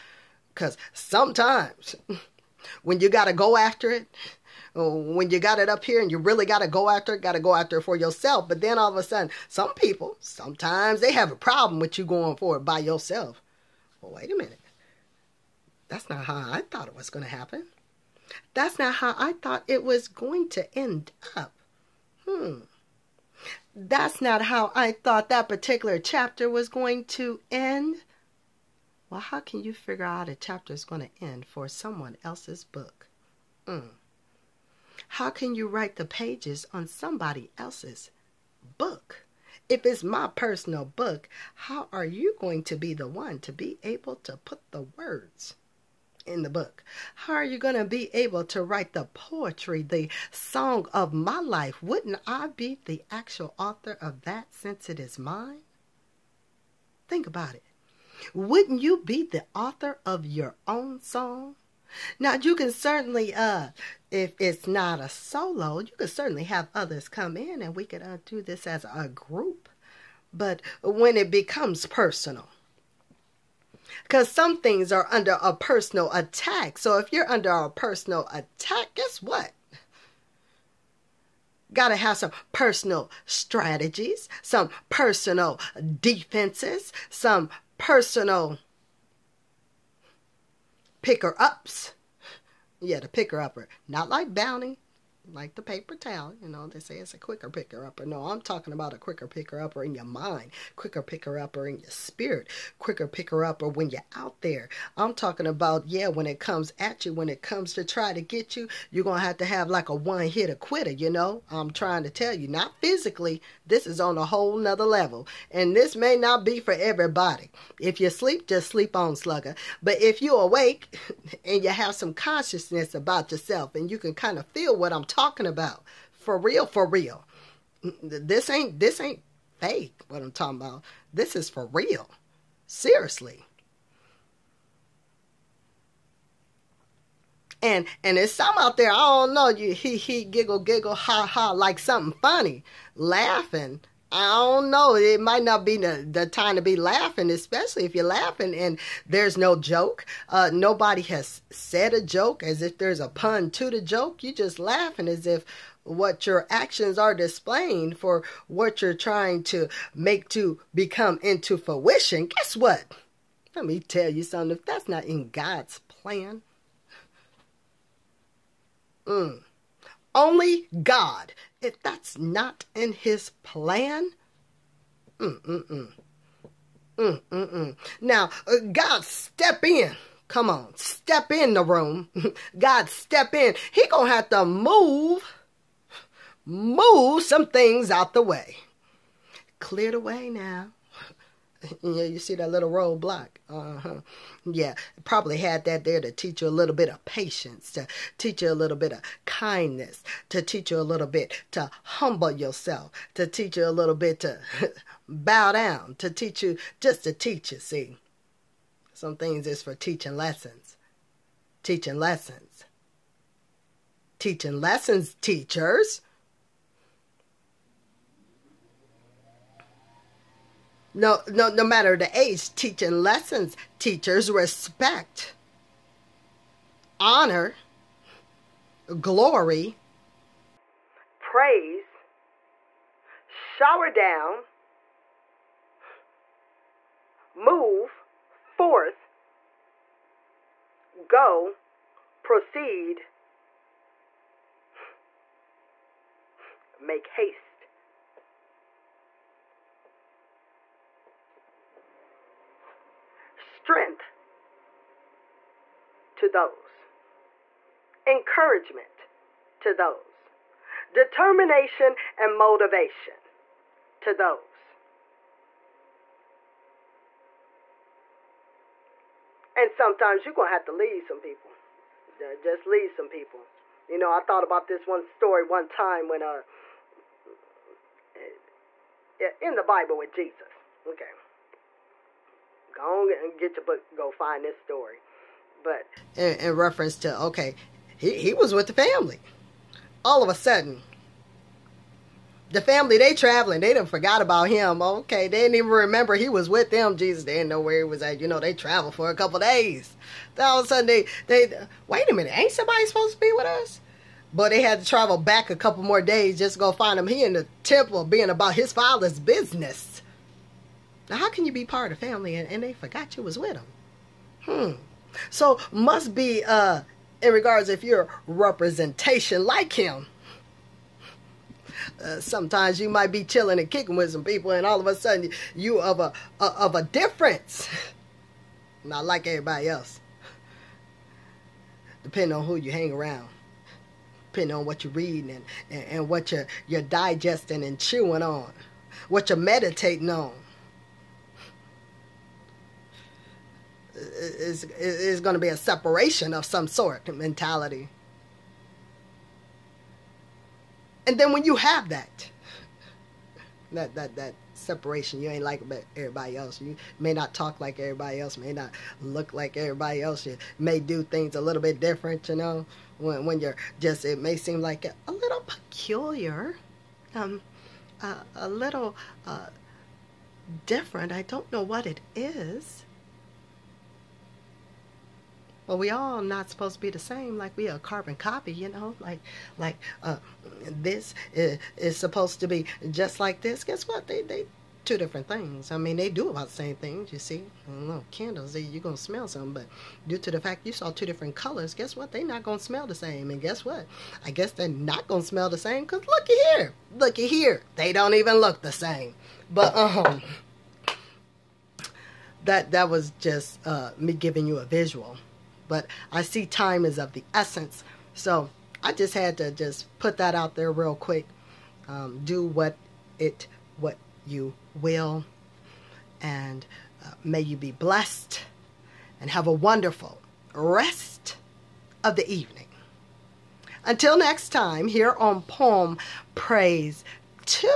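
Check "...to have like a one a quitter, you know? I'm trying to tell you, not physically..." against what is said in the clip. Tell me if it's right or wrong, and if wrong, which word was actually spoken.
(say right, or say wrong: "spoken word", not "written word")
right.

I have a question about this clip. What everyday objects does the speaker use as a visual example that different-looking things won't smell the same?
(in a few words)
Candles.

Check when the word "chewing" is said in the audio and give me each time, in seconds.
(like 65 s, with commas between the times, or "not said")
337 s.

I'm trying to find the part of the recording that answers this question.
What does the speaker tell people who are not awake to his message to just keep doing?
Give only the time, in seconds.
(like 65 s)
118 s.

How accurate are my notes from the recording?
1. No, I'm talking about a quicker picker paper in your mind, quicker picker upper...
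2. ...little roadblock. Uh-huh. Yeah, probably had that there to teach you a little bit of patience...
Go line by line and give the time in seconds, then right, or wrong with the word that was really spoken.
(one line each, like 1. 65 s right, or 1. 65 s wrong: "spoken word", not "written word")
1. 98 s wrong: "upper", not "paper"
2. 192 s right.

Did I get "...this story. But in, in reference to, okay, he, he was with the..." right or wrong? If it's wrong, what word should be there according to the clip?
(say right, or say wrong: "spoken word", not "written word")
right.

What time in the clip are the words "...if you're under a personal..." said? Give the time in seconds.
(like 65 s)
76 s.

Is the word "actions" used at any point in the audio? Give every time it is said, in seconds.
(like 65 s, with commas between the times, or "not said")
156 s.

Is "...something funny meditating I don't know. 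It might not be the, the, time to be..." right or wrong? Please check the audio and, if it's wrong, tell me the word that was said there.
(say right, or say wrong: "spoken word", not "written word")
wrong: "laughing", not "meditating".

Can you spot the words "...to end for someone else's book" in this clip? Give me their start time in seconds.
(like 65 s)
31 s.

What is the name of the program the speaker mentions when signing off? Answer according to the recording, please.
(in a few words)
Poem Praise.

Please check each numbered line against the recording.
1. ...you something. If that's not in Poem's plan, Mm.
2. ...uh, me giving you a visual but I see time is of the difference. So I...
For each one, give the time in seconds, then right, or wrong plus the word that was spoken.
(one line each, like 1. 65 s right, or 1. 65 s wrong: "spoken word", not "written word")
1. 164 s wrong: "God", not "Poem"
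2. 403 s wrong: "essence", not "difference".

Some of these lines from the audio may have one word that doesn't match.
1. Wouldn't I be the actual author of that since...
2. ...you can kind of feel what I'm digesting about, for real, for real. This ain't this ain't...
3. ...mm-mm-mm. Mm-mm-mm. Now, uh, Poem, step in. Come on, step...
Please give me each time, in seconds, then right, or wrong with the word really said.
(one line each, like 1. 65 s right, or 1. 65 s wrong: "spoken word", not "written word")
1. 51 s right
2. 123 s wrong: "talking", not "digesting"
3. 175 s wrong: "God", not "Poem".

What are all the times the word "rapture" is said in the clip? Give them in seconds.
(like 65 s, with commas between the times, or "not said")
not said.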